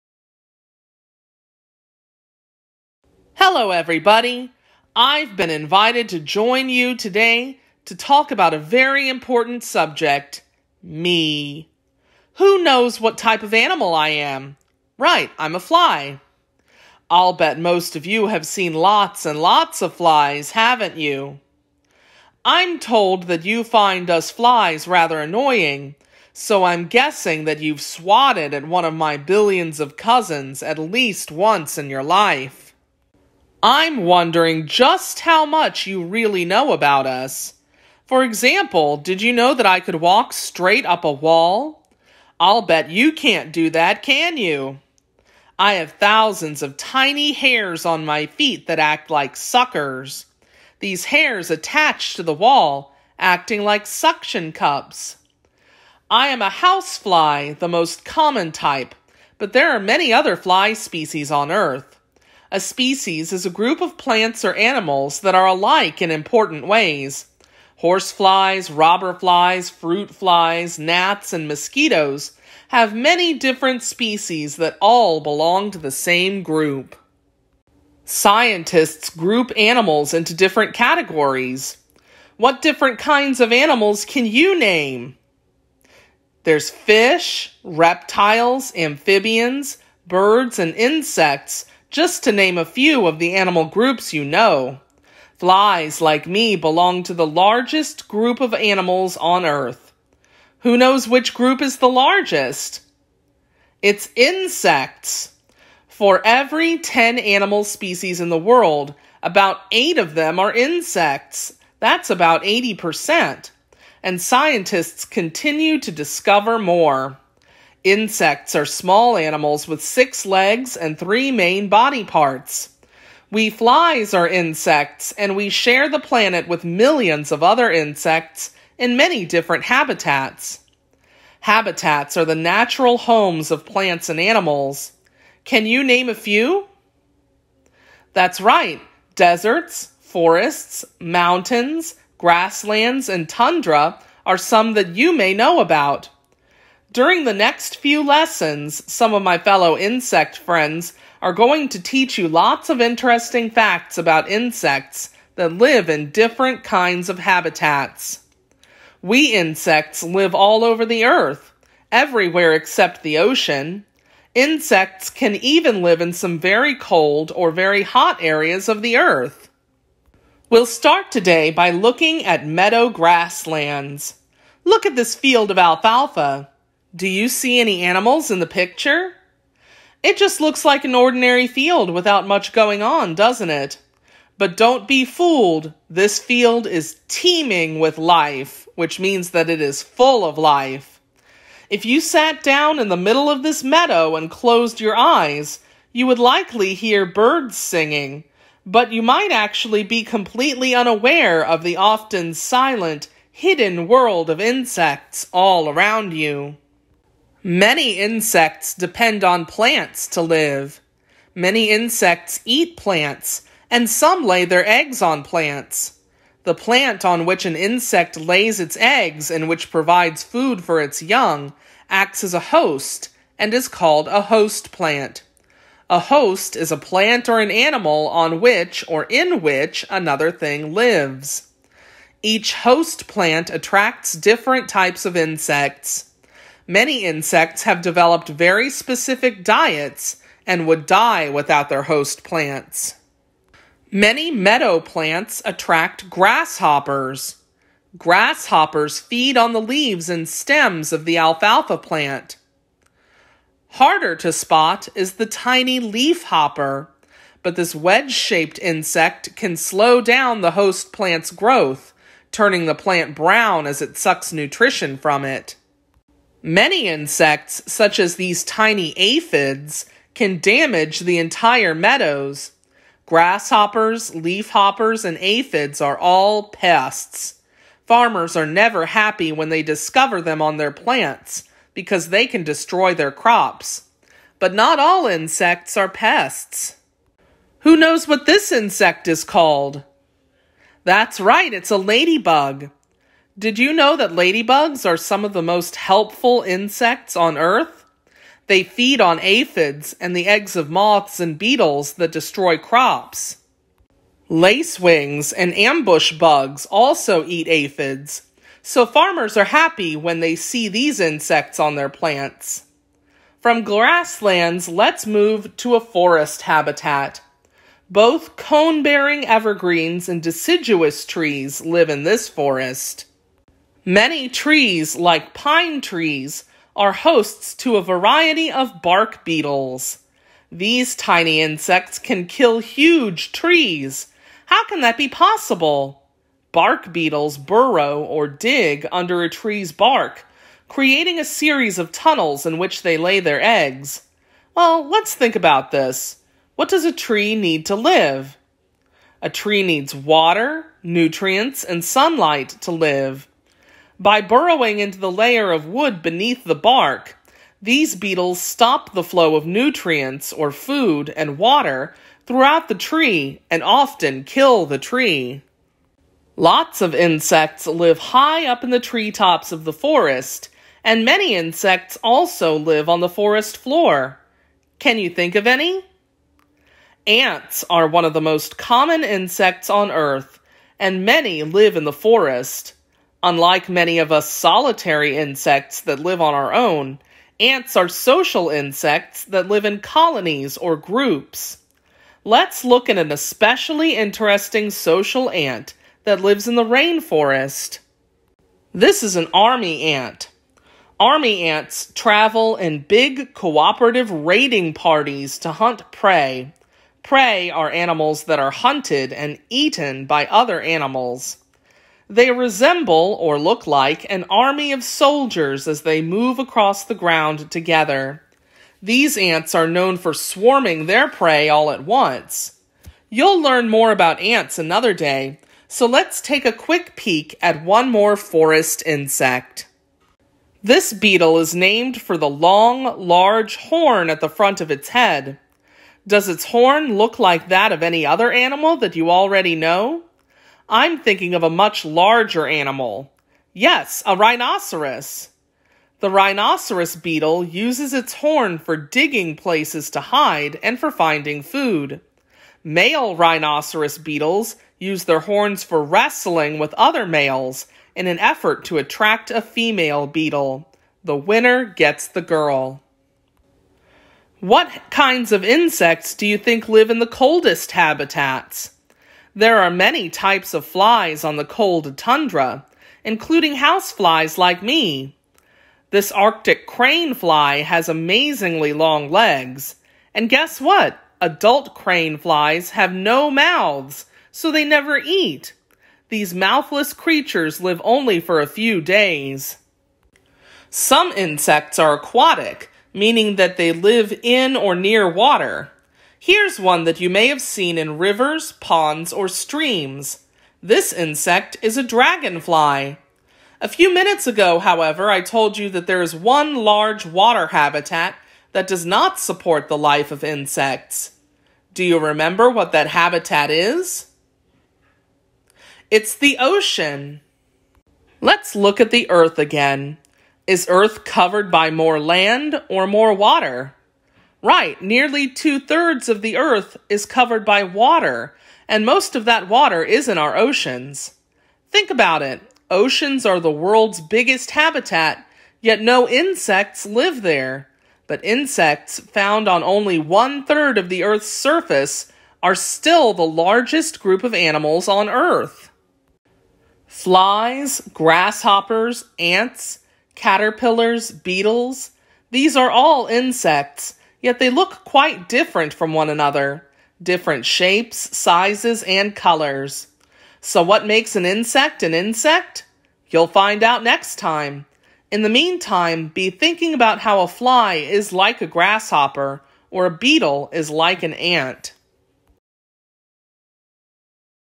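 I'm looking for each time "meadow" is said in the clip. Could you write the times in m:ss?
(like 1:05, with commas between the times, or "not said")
2:52, 3:13, 4:04, 4:31.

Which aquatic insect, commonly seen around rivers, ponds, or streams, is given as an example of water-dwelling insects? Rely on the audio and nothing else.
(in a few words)
Dragonfly.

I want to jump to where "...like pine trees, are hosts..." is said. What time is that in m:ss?
5:24.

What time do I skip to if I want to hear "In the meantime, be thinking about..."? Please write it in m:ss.
9:25.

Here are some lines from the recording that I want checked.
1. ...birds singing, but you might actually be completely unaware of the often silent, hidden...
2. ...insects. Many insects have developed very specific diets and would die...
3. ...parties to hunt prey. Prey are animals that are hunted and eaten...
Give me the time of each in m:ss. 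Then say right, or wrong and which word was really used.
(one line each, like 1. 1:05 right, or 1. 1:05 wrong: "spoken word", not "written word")
1. 3:17 right
2. 3:55 right
3. 6:44 right.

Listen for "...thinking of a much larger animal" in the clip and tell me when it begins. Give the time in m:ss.
7:20.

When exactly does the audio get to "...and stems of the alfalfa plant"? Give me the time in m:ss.
4:10.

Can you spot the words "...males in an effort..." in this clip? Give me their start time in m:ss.
7:37.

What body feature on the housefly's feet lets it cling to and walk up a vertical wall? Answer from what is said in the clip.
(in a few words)
Thousands of tiny hairs.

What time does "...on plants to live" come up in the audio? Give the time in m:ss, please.
3:29.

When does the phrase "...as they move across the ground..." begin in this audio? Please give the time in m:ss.
6:55.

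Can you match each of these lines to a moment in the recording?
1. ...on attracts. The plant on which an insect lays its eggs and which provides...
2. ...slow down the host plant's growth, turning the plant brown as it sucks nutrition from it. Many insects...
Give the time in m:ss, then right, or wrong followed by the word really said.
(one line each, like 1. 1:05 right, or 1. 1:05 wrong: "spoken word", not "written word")
1. 3:35 wrong: "plants", not "attracts"
2. 4:19 right.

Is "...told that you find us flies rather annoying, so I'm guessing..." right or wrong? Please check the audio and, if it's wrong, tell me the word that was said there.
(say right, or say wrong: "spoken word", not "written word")
right.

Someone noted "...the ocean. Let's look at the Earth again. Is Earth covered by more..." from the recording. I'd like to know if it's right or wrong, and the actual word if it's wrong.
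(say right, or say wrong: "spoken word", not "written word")
right.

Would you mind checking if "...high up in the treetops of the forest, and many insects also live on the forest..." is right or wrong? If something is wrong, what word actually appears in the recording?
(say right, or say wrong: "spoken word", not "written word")
right.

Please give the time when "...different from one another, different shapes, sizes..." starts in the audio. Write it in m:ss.
9:15.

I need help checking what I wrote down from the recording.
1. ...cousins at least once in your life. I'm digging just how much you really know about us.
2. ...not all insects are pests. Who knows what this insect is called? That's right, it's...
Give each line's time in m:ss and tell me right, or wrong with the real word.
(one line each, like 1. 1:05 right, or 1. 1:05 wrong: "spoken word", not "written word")
1. 0:29 wrong: "wondering", not "digging"
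2. 4:44 right.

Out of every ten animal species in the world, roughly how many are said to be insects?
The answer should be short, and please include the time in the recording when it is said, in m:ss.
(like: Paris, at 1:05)
8, at 1:49.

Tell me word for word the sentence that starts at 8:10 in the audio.
Some insects are aquatic, meaning that they live in or near water.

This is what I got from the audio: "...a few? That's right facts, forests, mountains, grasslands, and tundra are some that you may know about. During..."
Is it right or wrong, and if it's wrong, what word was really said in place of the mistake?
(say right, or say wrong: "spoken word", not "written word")
wrong: "deserts", not "facts".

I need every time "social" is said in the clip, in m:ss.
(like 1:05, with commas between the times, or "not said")
6:27, 6:34.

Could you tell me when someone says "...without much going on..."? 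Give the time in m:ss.
3:01.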